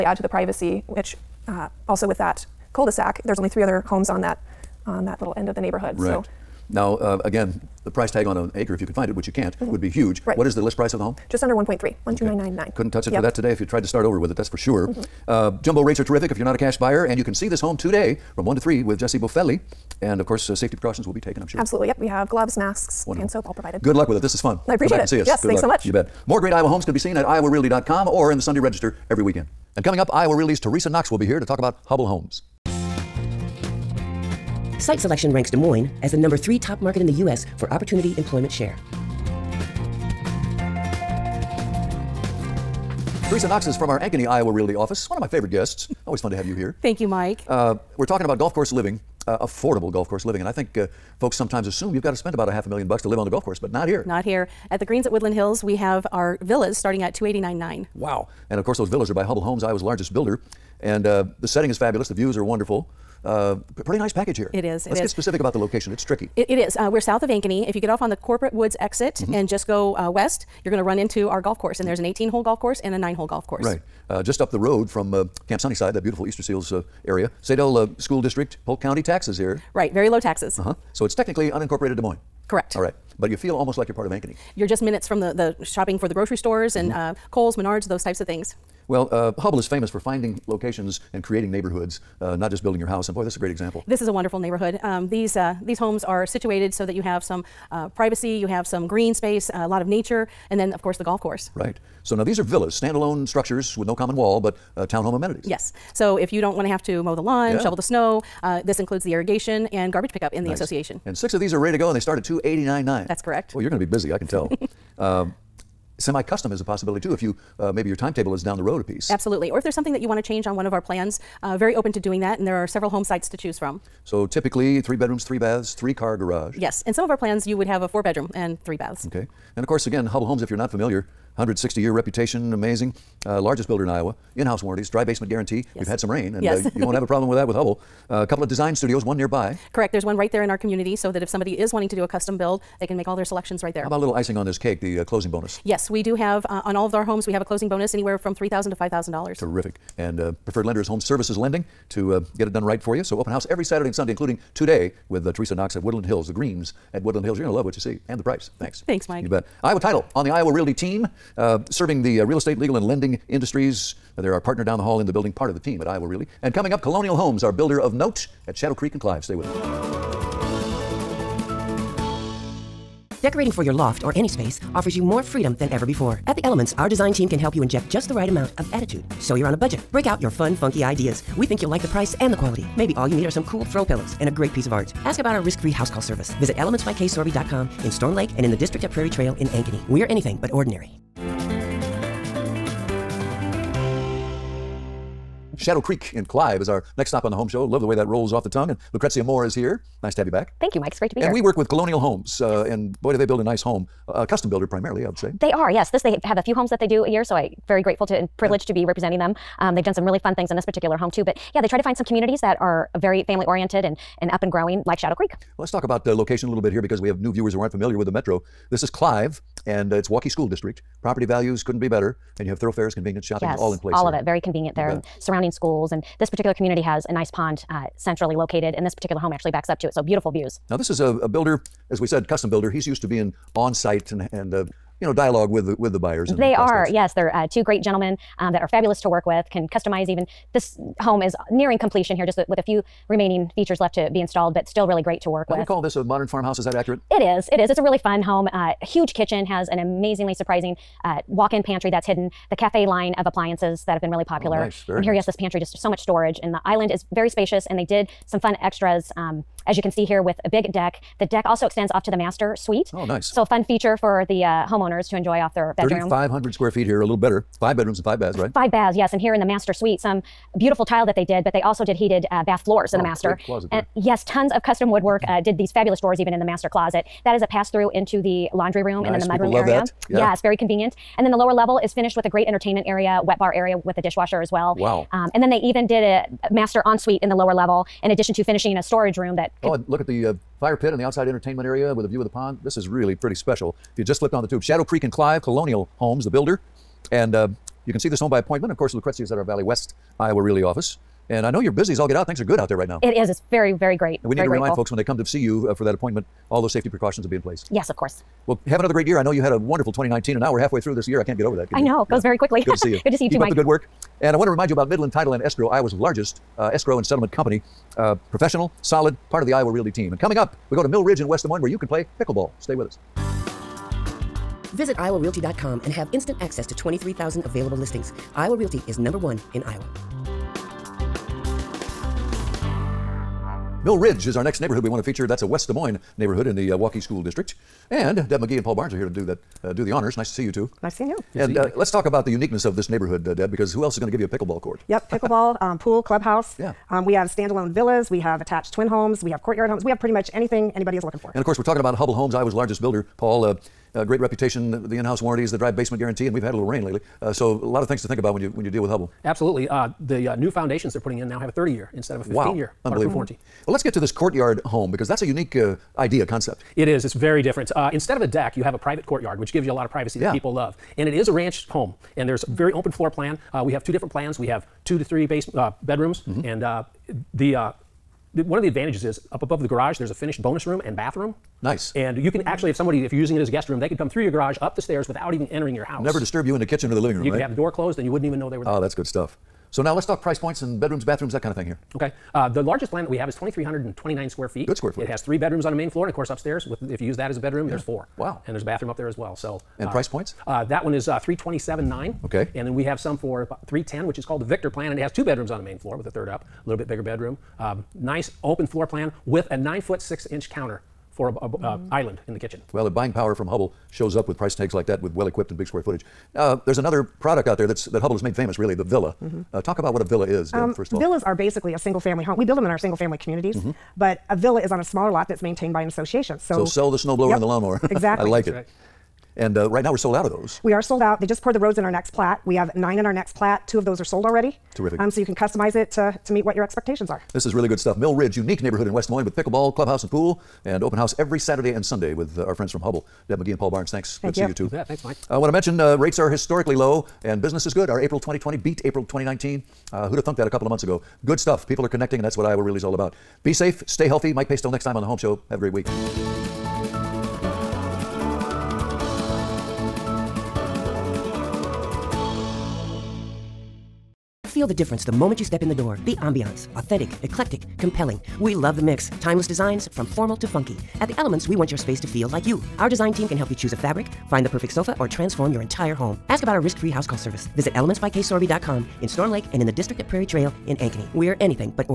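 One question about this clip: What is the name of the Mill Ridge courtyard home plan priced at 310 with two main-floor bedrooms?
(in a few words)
Victor.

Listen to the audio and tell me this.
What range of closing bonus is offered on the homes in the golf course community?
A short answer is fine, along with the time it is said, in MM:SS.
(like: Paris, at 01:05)
$3,000 to $5,000, at 02:28.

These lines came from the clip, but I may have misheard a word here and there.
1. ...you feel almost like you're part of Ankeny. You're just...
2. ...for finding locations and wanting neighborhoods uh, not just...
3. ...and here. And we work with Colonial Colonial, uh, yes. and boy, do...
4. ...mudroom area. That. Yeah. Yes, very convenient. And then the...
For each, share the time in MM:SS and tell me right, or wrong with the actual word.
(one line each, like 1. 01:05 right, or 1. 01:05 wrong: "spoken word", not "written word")
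1. 01:23 right
2. 01:29 wrong: "creating", not "wanting"
3. 03:21 wrong: "Homes", not "Colonial"
4. 04:39 right.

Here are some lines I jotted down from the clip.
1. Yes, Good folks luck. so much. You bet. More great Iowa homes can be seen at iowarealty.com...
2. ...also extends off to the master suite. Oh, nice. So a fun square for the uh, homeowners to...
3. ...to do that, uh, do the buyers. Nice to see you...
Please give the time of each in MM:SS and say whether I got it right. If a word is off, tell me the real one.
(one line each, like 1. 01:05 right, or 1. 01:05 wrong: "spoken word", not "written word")
1. 00:25 wrong: "thanks", not "folks"
2. 04:21 wrong: "feature", not "square"
3. 05:39 wrong: "honors", not "buyers".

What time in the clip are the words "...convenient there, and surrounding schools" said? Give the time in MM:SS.
03:44.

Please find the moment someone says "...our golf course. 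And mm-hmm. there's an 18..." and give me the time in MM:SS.
01:11.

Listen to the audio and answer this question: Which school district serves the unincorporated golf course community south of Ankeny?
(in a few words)
Saydel.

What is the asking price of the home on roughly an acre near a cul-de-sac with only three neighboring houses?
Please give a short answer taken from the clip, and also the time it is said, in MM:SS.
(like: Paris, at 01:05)
$1,299,900, at 00:12.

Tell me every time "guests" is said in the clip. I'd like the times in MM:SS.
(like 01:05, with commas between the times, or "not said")
00:45, 06:23.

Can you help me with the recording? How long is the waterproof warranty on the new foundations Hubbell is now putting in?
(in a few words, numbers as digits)
30 years.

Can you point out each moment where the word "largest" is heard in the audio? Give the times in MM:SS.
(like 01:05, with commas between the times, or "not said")
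00:59, 02:13, 05:15, 05:52, 06:32.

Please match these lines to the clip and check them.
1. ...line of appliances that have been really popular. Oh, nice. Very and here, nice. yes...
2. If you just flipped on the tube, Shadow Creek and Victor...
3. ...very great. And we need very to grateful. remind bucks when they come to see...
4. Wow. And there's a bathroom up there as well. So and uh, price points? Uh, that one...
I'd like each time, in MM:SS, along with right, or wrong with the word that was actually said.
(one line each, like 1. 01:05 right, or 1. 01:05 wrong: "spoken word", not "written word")
1. 04:12 right
2. 04:53 wrong: "Clive", not "Victor"
3. 05:03 wrong: "folks", not "bucks"
4. 06:38 right.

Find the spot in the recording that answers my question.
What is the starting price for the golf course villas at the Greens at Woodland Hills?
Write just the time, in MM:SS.
00:57.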